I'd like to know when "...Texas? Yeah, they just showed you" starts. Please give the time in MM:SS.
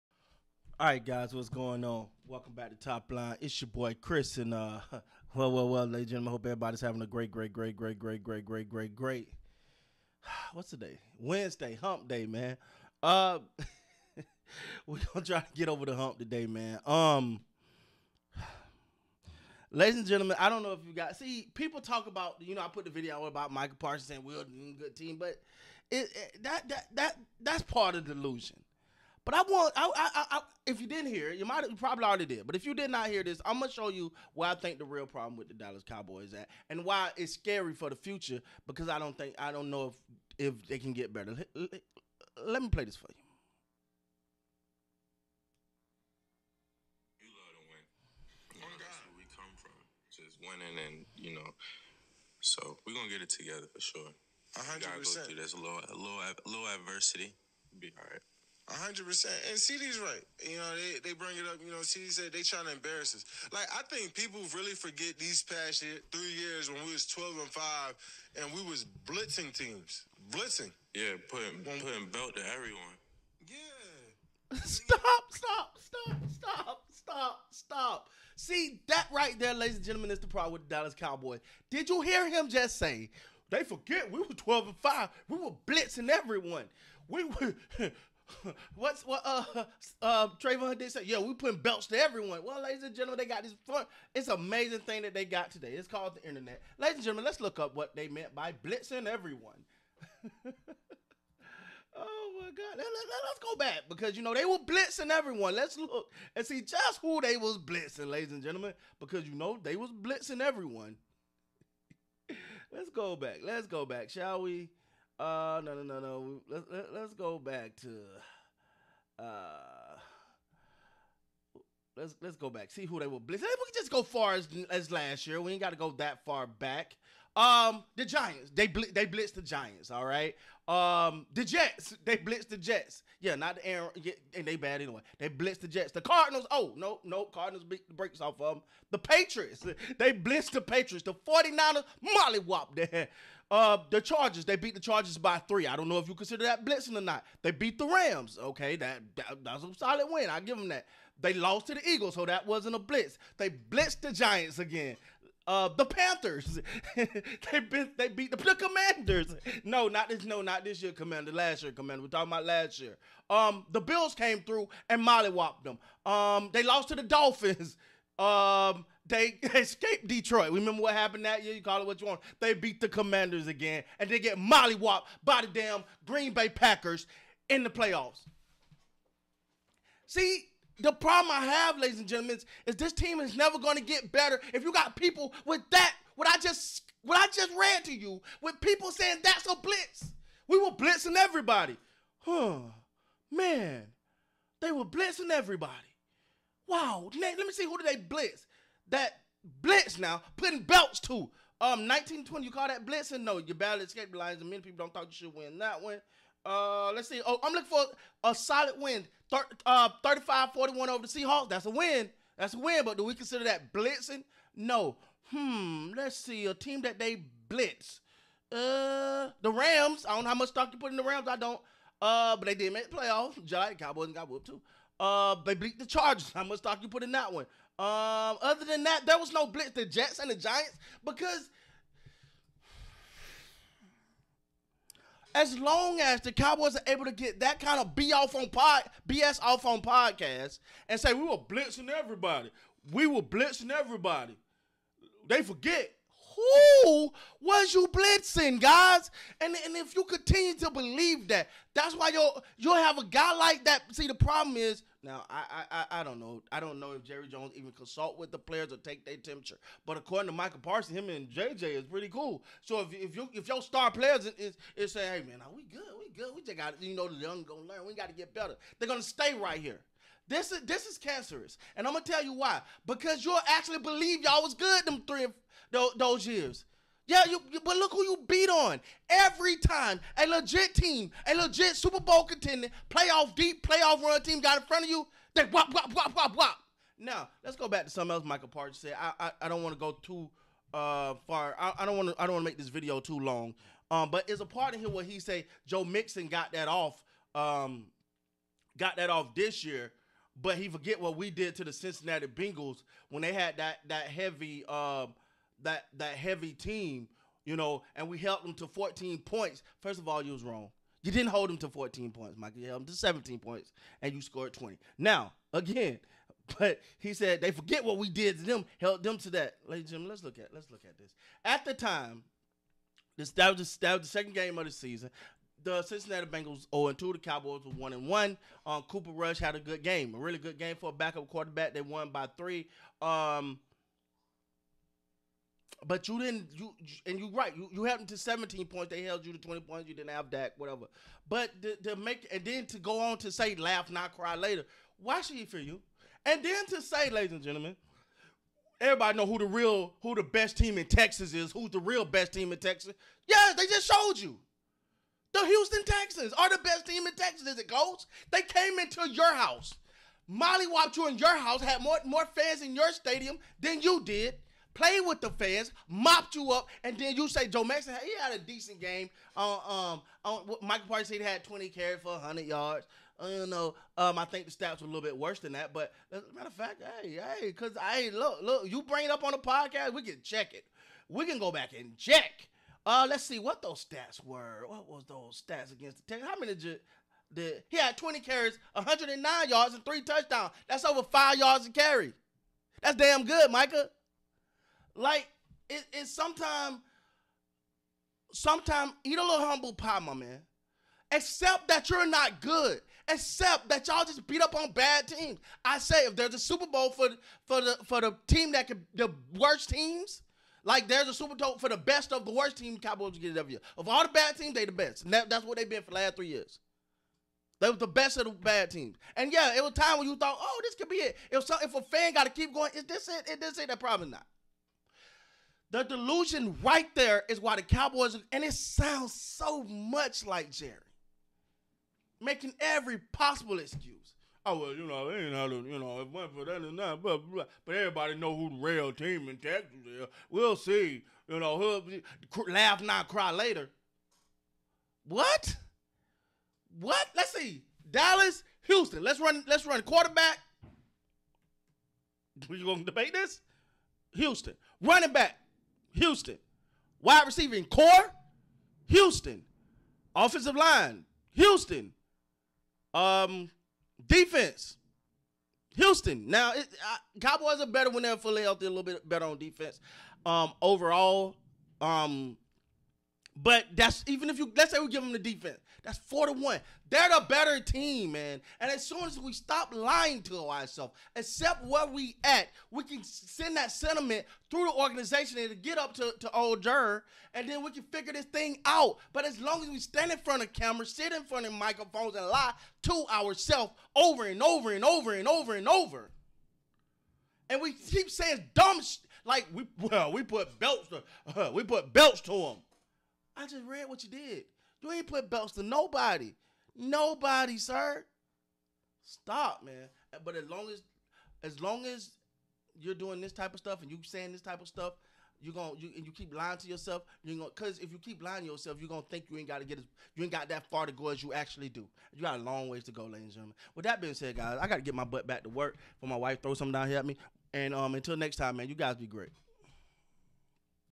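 05:52.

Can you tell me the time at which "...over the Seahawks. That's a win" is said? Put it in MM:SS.
03:30.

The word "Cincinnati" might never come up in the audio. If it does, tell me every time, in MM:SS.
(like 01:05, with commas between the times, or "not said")
05:01, 05:25.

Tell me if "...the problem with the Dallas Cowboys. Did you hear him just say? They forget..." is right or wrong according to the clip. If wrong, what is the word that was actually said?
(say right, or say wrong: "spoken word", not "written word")
right.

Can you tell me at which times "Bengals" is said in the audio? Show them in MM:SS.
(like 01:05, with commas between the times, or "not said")
05:02, 05:26.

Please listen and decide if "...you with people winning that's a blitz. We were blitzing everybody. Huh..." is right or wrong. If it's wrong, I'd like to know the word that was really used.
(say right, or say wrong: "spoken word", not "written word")
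wrong: "saying", not "winning".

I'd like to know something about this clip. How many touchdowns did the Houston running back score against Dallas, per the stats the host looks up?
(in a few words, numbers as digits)
3.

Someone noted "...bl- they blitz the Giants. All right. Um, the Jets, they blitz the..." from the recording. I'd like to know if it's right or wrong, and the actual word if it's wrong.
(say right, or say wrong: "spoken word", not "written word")
right.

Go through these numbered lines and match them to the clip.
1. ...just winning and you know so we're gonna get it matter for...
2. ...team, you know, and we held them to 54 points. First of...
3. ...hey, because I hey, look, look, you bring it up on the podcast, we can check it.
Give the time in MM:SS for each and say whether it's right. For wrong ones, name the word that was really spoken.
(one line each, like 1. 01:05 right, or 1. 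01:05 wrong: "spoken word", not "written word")
1. 00:50 wrong: "together", not "matter"
2. 05:06 wrong: "14", not "54"
3. 06:17 right.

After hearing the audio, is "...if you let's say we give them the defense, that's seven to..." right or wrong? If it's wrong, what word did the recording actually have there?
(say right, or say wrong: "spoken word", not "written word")
wrong: "four", not "seven".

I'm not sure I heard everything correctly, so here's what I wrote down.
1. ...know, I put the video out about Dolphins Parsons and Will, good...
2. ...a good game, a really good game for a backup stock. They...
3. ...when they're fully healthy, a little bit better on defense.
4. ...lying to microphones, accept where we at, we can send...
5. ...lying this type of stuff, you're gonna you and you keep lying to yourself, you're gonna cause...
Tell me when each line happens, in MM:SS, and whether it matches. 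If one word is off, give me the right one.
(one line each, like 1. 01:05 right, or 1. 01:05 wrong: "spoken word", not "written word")
1. 00:22 wrong: "Micah", not "Dolphins"
2. 05:29 wrong: "quarterback", not "stock"
3. 07:47 right
4. 07:59 wrong: "ourselves", not "microphones"
5. 08:34 wrong: "saying", not "lying".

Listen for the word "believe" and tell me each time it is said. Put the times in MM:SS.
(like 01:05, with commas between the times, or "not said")
04:10, 04:33.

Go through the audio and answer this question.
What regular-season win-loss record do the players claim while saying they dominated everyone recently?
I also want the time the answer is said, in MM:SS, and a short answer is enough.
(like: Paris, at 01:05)
12 and 5, at 01:07.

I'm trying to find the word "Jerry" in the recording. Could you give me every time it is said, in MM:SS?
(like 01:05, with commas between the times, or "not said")
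04:17, 07:10.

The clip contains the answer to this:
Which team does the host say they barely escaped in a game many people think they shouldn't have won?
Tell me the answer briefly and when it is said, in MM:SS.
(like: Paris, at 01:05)
Detroit, at 02:49.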